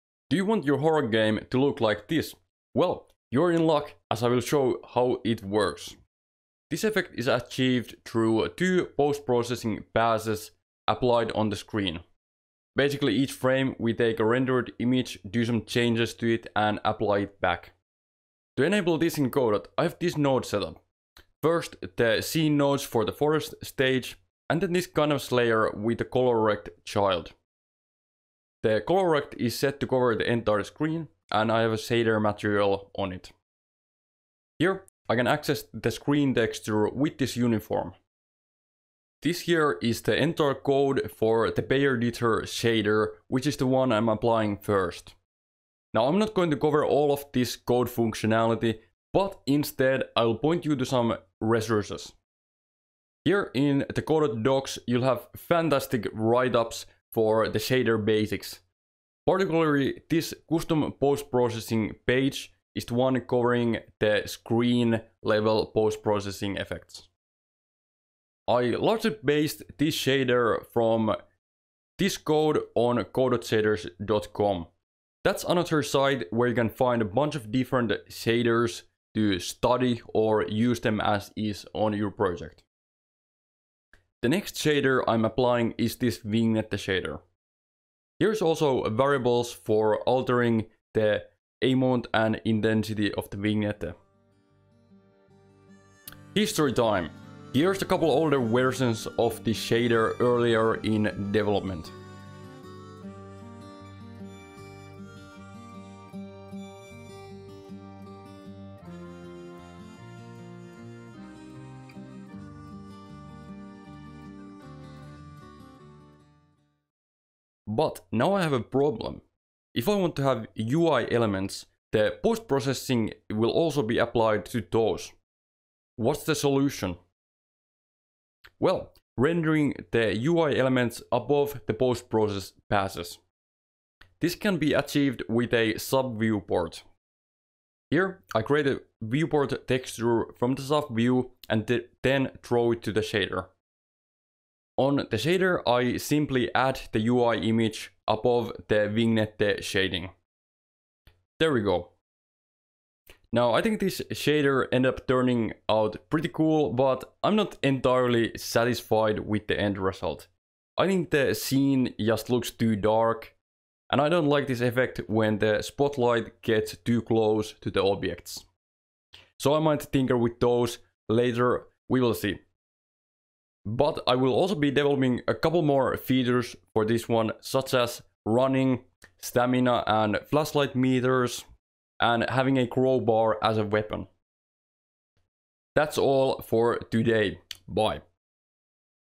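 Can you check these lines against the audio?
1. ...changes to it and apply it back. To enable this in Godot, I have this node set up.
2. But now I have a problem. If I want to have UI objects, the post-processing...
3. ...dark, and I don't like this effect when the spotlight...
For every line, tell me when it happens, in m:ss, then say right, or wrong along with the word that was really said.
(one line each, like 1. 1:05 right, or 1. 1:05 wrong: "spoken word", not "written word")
1. 0:15 right
2. 1:57 wrong: "elements", not "objects"
3. 2:42 right.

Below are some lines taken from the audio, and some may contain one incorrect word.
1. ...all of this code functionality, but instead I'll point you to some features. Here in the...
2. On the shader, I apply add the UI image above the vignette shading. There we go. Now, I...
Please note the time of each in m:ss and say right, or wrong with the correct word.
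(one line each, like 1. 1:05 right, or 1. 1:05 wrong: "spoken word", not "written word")
1. 0:46 wrong: "resources", not "features"
2. 2:24 wrong: "simply", not "apply".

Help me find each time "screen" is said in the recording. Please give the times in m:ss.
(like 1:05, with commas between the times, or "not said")
0:11, 0:30, 0:35, 1:04.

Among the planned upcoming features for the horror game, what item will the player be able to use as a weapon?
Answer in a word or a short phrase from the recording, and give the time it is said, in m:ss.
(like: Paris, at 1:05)
crowbar, at 3:02.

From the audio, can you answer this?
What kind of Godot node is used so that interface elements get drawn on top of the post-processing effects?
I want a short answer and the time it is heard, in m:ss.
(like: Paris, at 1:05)
sub-viewport, at 2:15.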